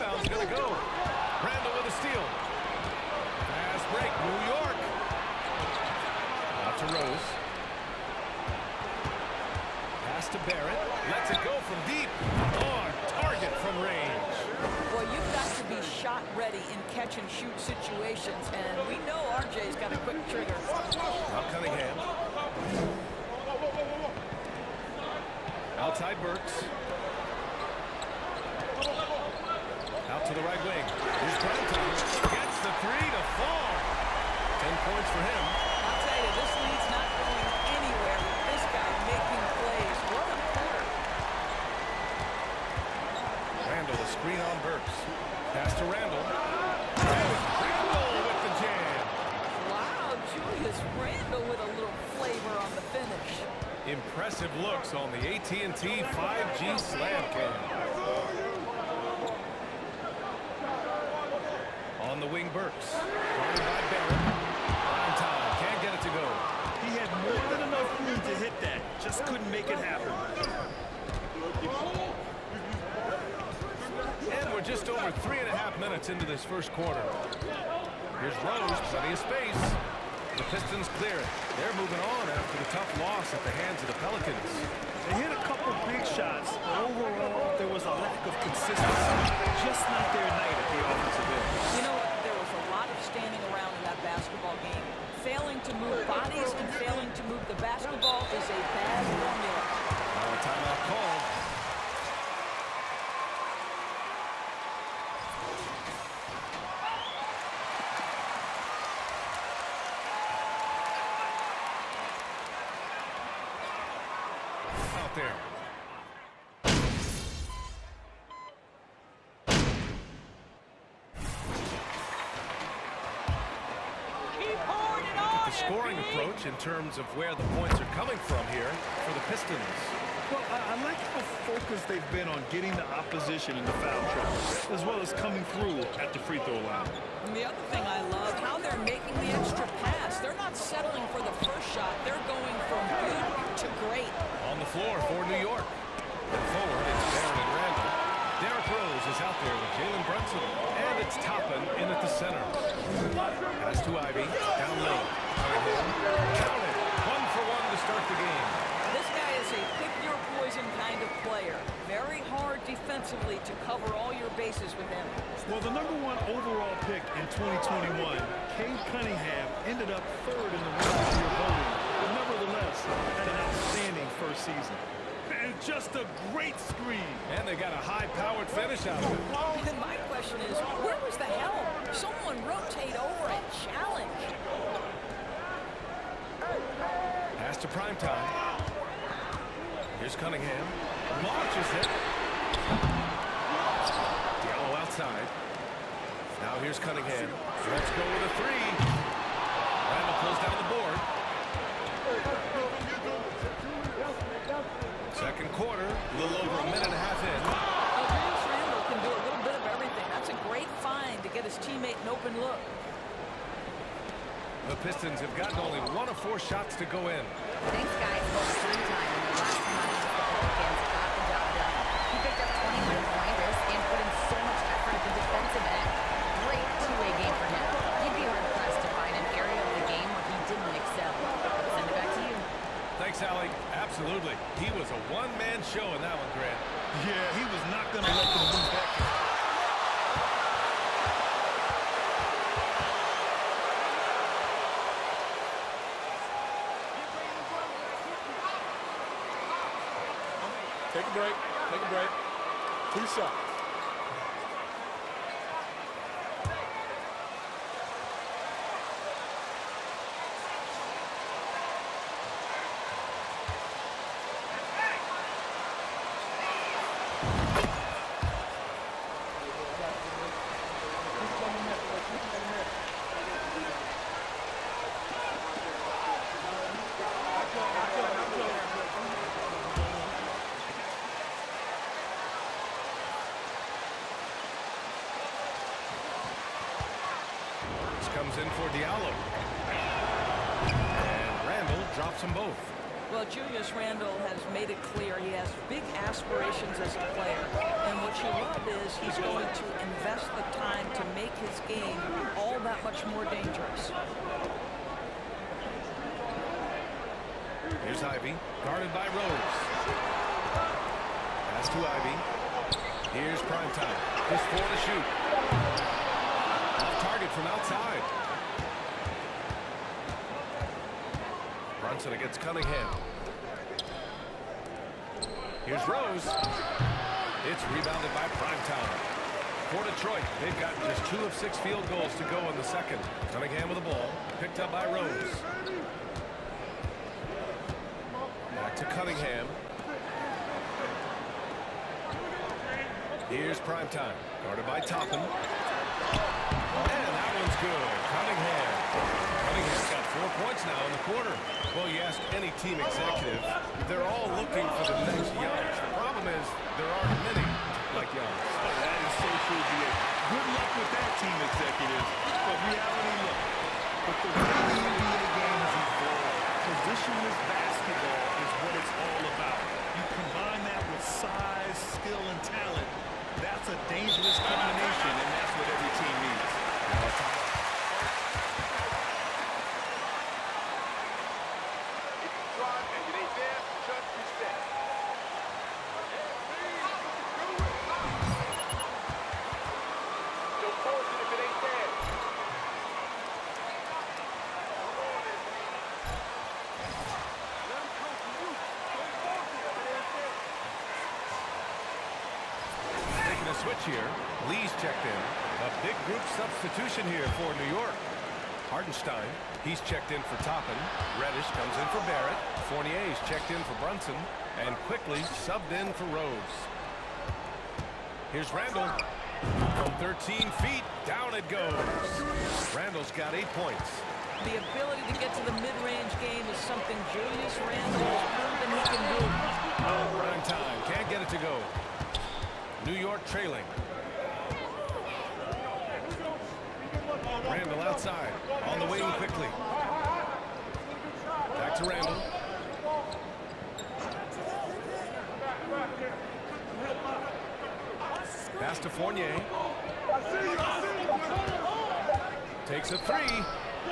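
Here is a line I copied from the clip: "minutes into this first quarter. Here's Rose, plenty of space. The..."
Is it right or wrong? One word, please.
right.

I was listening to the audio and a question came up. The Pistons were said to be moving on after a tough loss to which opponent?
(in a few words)
Pelicans.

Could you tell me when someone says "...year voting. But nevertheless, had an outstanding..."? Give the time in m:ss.
2:51.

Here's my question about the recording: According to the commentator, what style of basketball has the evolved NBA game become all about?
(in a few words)
Positionless basketball.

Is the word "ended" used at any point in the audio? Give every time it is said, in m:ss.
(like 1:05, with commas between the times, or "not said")
2:49.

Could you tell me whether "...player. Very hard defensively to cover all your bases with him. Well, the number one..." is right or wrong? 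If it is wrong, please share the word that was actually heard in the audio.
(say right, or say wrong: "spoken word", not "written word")
right.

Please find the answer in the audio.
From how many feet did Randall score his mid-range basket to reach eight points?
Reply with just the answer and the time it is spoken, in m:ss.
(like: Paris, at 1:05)
13, at 7:00.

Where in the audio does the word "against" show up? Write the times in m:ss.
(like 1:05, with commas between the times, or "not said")
5:22.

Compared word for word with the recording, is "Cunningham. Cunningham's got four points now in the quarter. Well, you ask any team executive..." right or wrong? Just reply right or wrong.
right.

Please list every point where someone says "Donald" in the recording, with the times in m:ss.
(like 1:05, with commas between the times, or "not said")
not said.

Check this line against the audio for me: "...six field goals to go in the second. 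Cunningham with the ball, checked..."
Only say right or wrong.
wrong.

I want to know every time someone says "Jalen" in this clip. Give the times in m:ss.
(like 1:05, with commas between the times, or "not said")
2:29.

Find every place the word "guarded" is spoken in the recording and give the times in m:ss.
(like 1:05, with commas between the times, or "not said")
5:08, 5:44.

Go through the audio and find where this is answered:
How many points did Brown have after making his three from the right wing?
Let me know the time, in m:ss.
0:34.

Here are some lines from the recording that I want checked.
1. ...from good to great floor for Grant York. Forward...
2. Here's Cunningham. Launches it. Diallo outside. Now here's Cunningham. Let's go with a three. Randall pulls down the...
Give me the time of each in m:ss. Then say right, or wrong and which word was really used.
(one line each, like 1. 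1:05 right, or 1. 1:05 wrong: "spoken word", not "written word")
1. 2:22 wrong: "New", not "Grant"
2. 3:10 right.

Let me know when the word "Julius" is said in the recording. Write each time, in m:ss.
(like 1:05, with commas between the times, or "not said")
0:50, 7:07.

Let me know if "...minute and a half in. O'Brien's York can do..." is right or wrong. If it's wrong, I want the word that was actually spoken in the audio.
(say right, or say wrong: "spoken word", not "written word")
wrong: "Randall", not "York".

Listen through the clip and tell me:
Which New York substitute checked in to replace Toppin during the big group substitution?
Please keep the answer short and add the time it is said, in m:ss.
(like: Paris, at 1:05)
Hartenstein, at 6:48.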